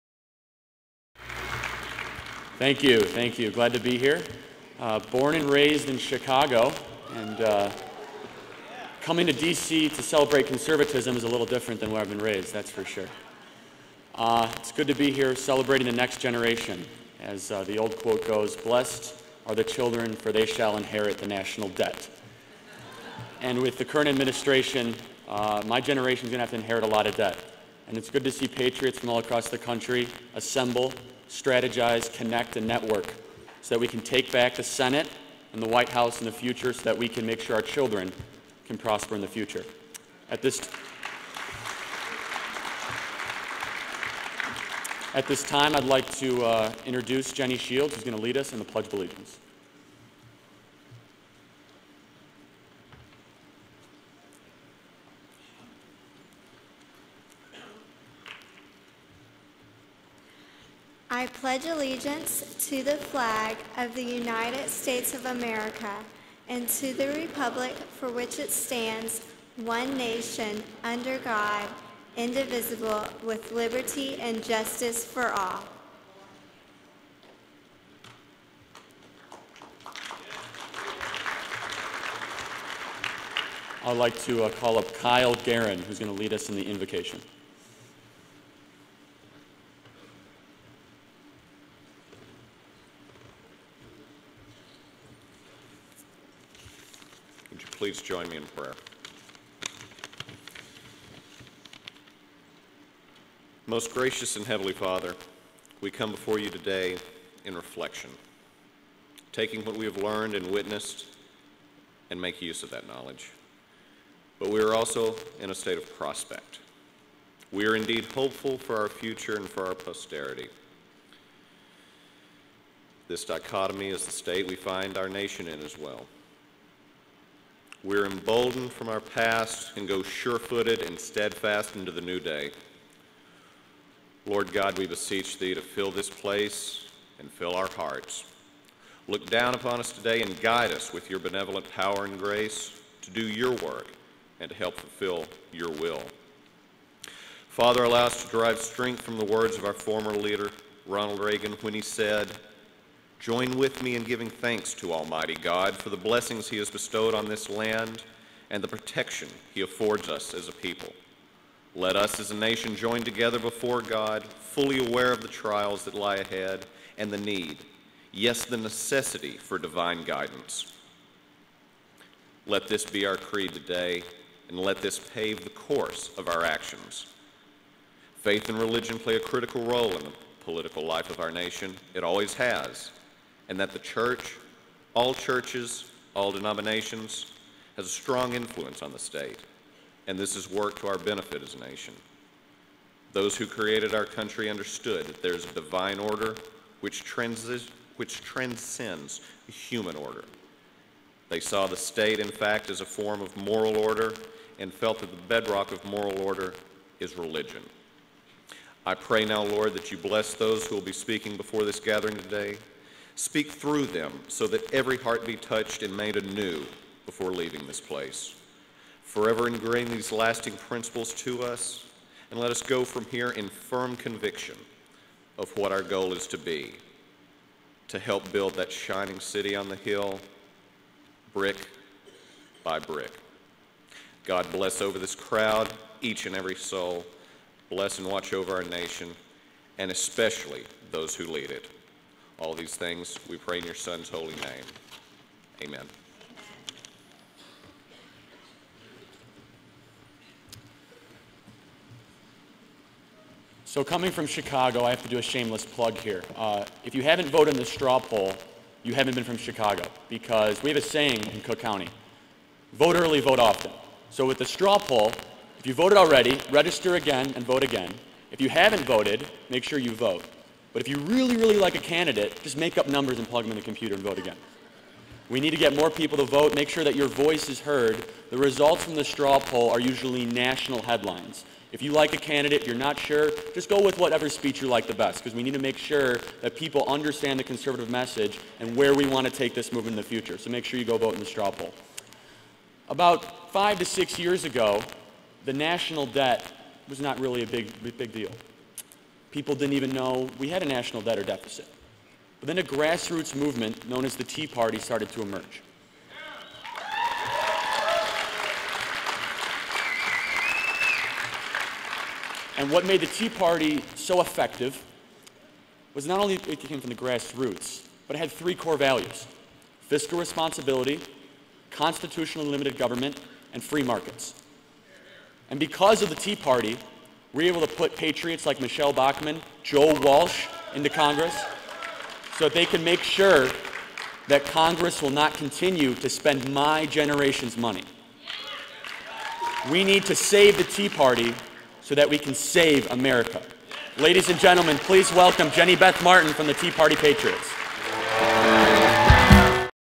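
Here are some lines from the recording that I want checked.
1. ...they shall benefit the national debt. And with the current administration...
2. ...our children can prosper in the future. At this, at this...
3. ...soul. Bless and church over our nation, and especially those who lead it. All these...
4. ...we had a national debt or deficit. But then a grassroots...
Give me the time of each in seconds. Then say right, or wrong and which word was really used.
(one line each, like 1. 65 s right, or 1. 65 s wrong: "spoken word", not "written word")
1. 20 s wrong: "inherit", not "benefit"
2. 37 s right
3. 236 s wrong: "watch", not "church"
4. 300 s right.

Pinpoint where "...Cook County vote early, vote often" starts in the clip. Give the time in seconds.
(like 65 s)
261 s.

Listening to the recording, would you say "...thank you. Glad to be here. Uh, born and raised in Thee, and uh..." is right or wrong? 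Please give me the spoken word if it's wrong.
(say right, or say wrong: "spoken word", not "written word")
wrong: "Chicago", not "Thee".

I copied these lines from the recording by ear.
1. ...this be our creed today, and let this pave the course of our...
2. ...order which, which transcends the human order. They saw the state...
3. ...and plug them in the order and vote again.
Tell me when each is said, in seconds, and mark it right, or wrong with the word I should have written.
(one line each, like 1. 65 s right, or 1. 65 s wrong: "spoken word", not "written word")
1. 172 s right
2. 195 s right
3. 273 s wrong: "computer", not "order".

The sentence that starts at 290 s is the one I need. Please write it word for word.
So make sure you go vote in the straw poll.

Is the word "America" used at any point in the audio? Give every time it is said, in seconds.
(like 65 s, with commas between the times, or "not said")
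65 s, 342 s.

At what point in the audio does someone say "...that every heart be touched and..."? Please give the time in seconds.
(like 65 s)
214 s.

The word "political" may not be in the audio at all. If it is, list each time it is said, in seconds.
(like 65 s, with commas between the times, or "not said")
180 s.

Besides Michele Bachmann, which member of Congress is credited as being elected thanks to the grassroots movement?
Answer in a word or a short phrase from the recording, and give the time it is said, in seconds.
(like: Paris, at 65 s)
Joe Walsh, at 329 s.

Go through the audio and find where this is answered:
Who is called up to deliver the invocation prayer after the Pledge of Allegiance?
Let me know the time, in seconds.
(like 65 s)
84 s.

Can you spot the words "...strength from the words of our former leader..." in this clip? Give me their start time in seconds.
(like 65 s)
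148 s.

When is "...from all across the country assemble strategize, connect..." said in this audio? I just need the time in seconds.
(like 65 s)
28 s.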